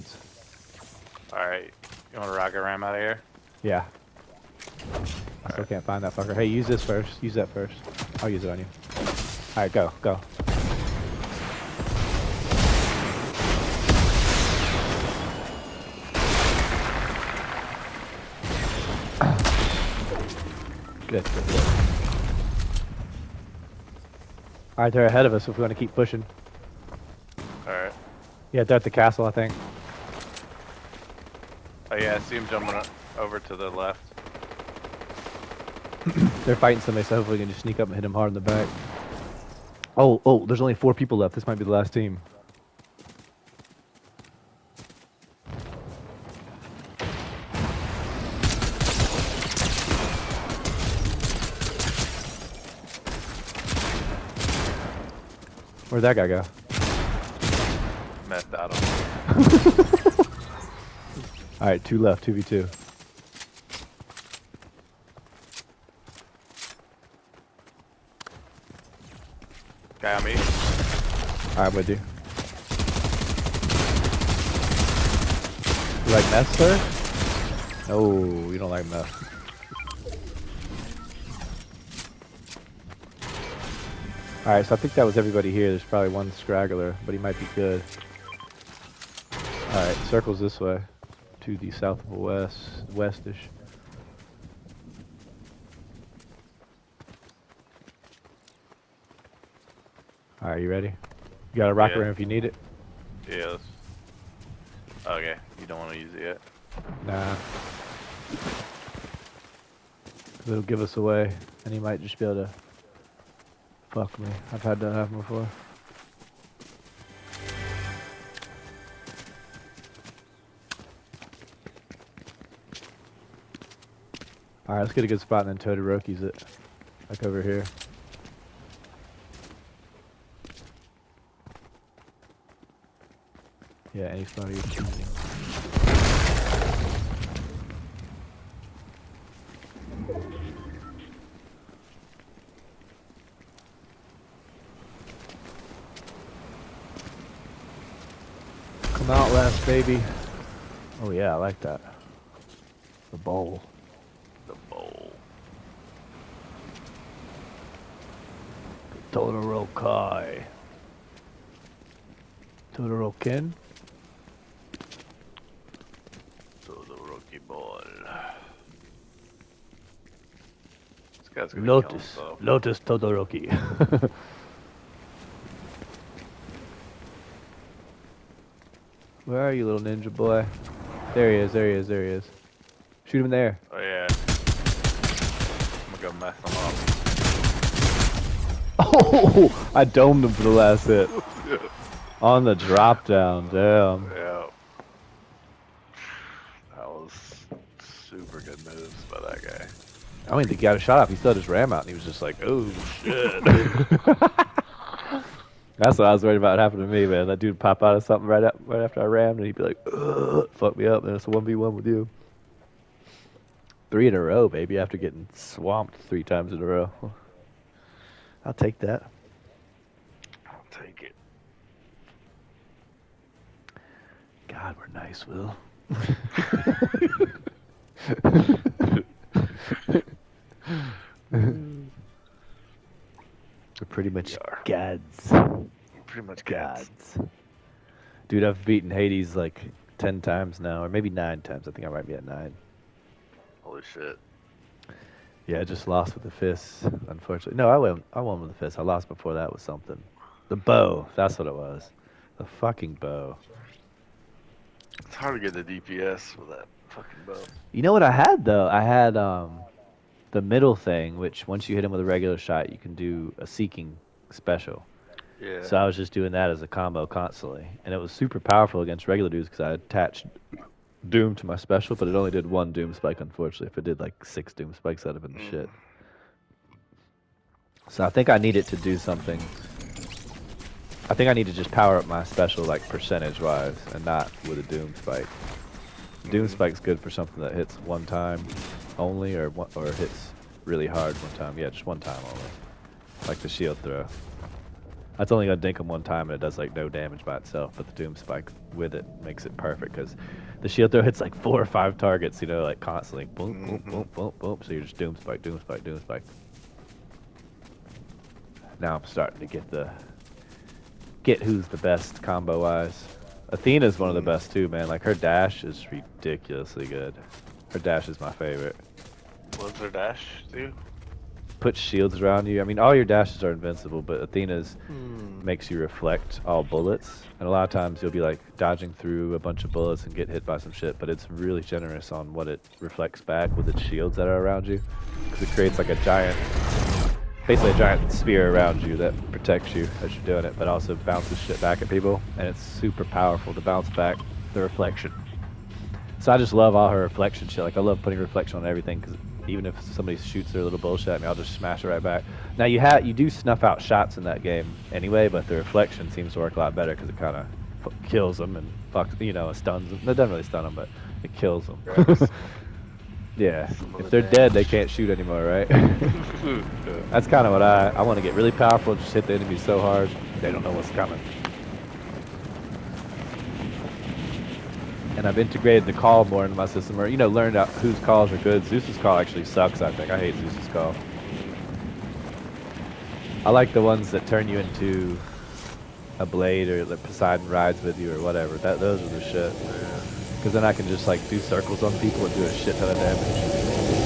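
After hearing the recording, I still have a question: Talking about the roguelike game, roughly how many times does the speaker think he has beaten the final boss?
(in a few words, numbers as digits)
9.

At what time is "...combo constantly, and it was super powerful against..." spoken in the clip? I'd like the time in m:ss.
4:26.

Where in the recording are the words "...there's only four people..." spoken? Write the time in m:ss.
0:40.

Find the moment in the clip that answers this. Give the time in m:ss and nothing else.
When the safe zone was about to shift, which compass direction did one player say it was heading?
1:31.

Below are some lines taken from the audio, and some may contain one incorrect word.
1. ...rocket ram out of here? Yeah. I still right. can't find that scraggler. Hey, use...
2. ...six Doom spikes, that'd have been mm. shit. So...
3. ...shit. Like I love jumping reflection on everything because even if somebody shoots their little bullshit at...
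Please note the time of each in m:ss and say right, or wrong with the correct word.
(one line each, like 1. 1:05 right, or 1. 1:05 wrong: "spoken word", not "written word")
1. 0:02 wrong: "fucker", not "scraggler"
2. 4:34 right
3. 5:47 wrong: "putting", not "jumping".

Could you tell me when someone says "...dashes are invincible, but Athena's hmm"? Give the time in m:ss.
5:23.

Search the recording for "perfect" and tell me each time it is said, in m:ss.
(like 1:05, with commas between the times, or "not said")
4:59.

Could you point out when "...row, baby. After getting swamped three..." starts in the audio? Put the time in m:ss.
3:34.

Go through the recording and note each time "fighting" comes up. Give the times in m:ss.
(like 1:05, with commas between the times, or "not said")
0:36.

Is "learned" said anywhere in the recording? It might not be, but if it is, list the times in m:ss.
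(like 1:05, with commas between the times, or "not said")
6:17.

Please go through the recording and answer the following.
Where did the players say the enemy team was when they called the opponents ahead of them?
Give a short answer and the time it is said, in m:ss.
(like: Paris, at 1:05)
The castle, at 0:28.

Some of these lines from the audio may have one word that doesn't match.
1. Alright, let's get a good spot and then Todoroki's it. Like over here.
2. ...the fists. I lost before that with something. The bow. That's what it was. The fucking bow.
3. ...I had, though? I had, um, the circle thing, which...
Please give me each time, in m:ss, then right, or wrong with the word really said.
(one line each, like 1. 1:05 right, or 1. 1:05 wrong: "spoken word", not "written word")
1. 2:04 right
2. 4:08 right
3. 4:18 wrong: "middle", not "circle".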